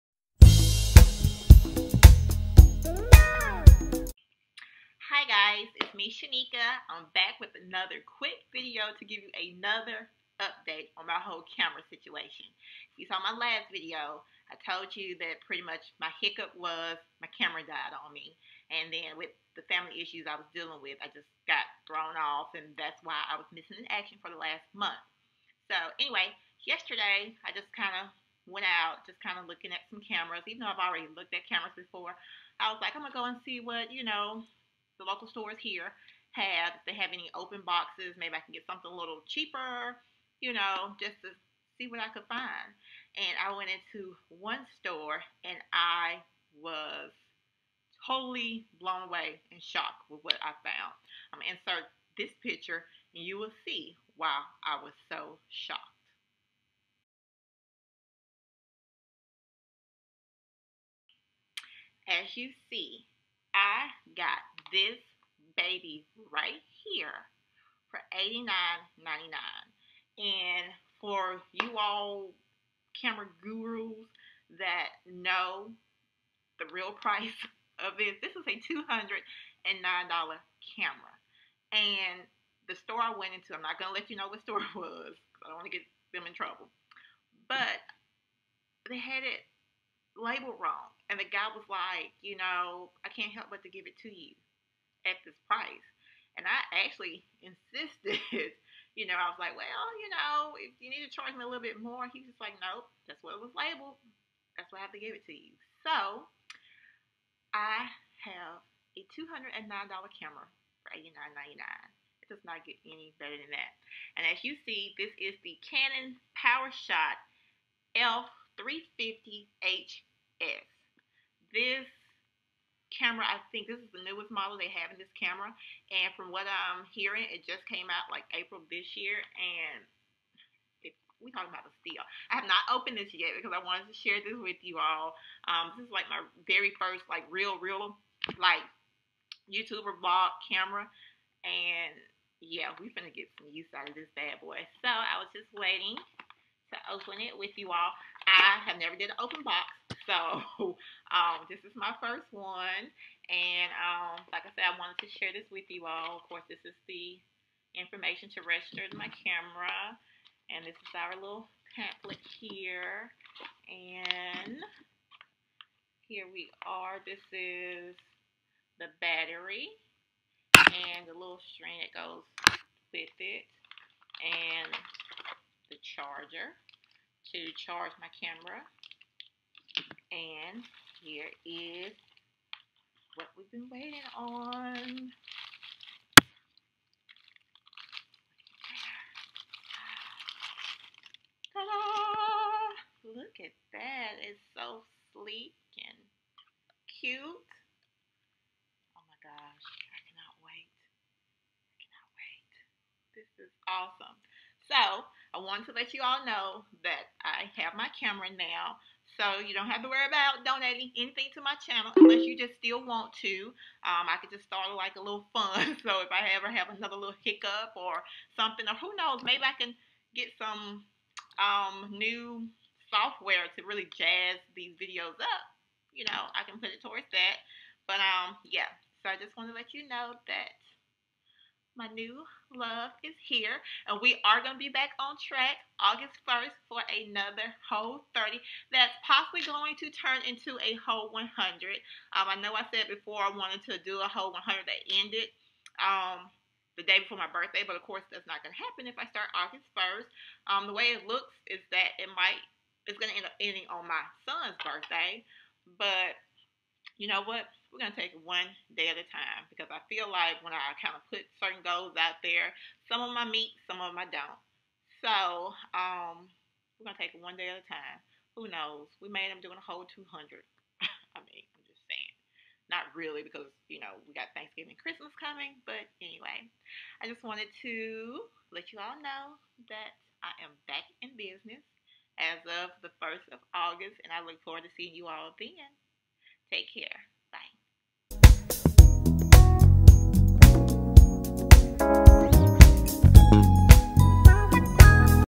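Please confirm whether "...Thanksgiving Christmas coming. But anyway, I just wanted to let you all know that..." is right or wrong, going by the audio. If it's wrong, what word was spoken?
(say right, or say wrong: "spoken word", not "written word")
right.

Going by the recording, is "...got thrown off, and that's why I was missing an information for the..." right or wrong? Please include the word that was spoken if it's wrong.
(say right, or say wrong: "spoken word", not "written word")
wrong: "action", not "information".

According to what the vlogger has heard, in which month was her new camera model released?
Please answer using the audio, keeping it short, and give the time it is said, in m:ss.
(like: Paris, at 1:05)
April, at 2:08.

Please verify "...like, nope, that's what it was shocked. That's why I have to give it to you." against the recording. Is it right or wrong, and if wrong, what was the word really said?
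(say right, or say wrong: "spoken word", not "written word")
wrong: "labeled", not "shocked".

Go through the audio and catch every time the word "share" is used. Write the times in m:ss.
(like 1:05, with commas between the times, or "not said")
2:13, 2:35.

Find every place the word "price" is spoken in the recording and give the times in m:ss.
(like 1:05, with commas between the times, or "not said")
1:16, 1:35.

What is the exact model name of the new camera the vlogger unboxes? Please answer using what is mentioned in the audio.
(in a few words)
Canon PowerShot ELPH 350 HS.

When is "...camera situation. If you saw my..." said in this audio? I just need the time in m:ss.
0:11.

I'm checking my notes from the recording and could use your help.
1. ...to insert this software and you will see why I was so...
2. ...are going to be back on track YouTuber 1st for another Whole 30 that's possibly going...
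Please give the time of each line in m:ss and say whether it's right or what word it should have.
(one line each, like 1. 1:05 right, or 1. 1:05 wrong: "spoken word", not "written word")
1. 0:51 wrong: "picture", not "software"
2. 3:54 wrong: "August", not "YouTuber".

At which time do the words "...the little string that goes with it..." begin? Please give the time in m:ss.
2:51.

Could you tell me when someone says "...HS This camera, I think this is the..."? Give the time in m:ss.
1:59.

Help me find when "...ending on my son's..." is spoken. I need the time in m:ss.
4:13.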